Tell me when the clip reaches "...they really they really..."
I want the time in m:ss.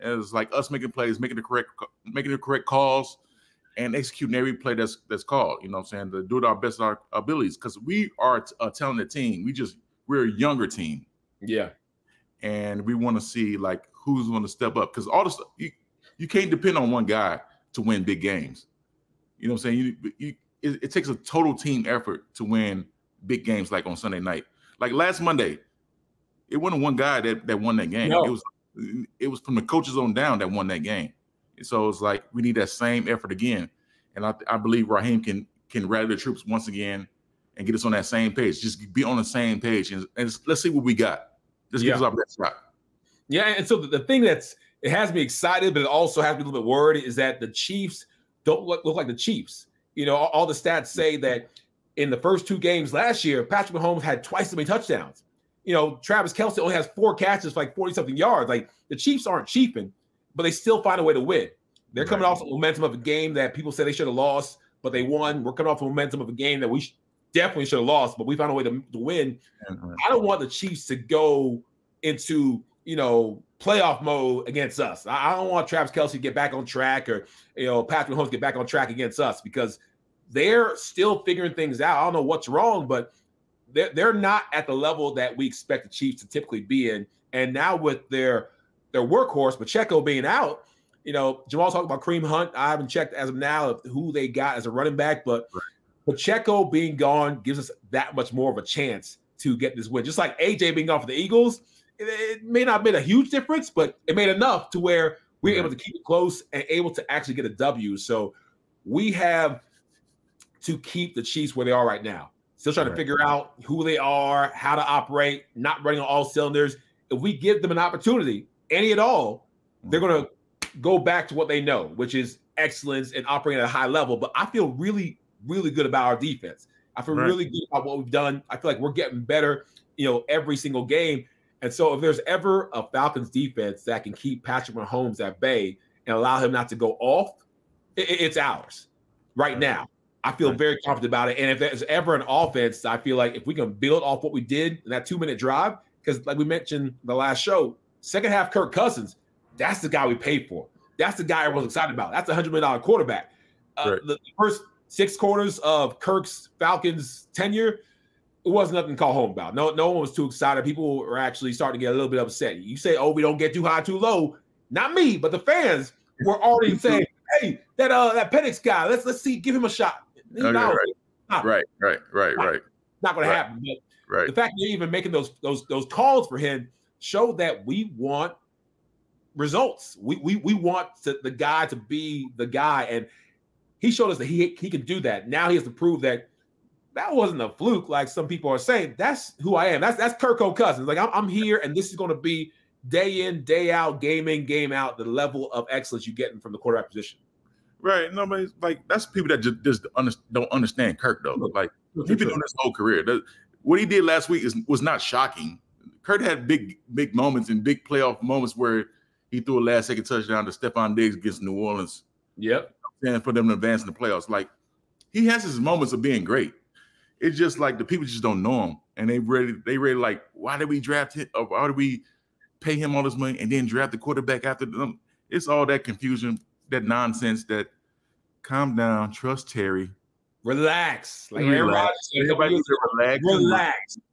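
3:39.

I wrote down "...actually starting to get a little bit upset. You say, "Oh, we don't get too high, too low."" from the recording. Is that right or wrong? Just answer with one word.
right.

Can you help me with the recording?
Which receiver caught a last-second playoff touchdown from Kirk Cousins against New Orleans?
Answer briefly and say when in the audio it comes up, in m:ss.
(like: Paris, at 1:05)
Stefon Diggs, at 3:30.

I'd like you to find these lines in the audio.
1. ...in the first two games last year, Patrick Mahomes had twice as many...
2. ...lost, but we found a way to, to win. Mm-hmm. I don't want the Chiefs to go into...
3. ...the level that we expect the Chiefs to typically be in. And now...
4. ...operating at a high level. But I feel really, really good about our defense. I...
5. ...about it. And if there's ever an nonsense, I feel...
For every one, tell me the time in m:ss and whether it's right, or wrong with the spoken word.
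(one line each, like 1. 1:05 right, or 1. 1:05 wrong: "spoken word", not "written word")
1. 0:51 right
2. 1:07 right
3. 1:24 right
4. 2:03 right
5. 2:21 wrong: "offense", not "nonsense".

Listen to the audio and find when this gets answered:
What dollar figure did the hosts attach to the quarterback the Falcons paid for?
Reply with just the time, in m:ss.
2:32.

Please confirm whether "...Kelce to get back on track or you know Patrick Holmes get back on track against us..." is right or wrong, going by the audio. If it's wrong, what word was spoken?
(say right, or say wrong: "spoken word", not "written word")
right.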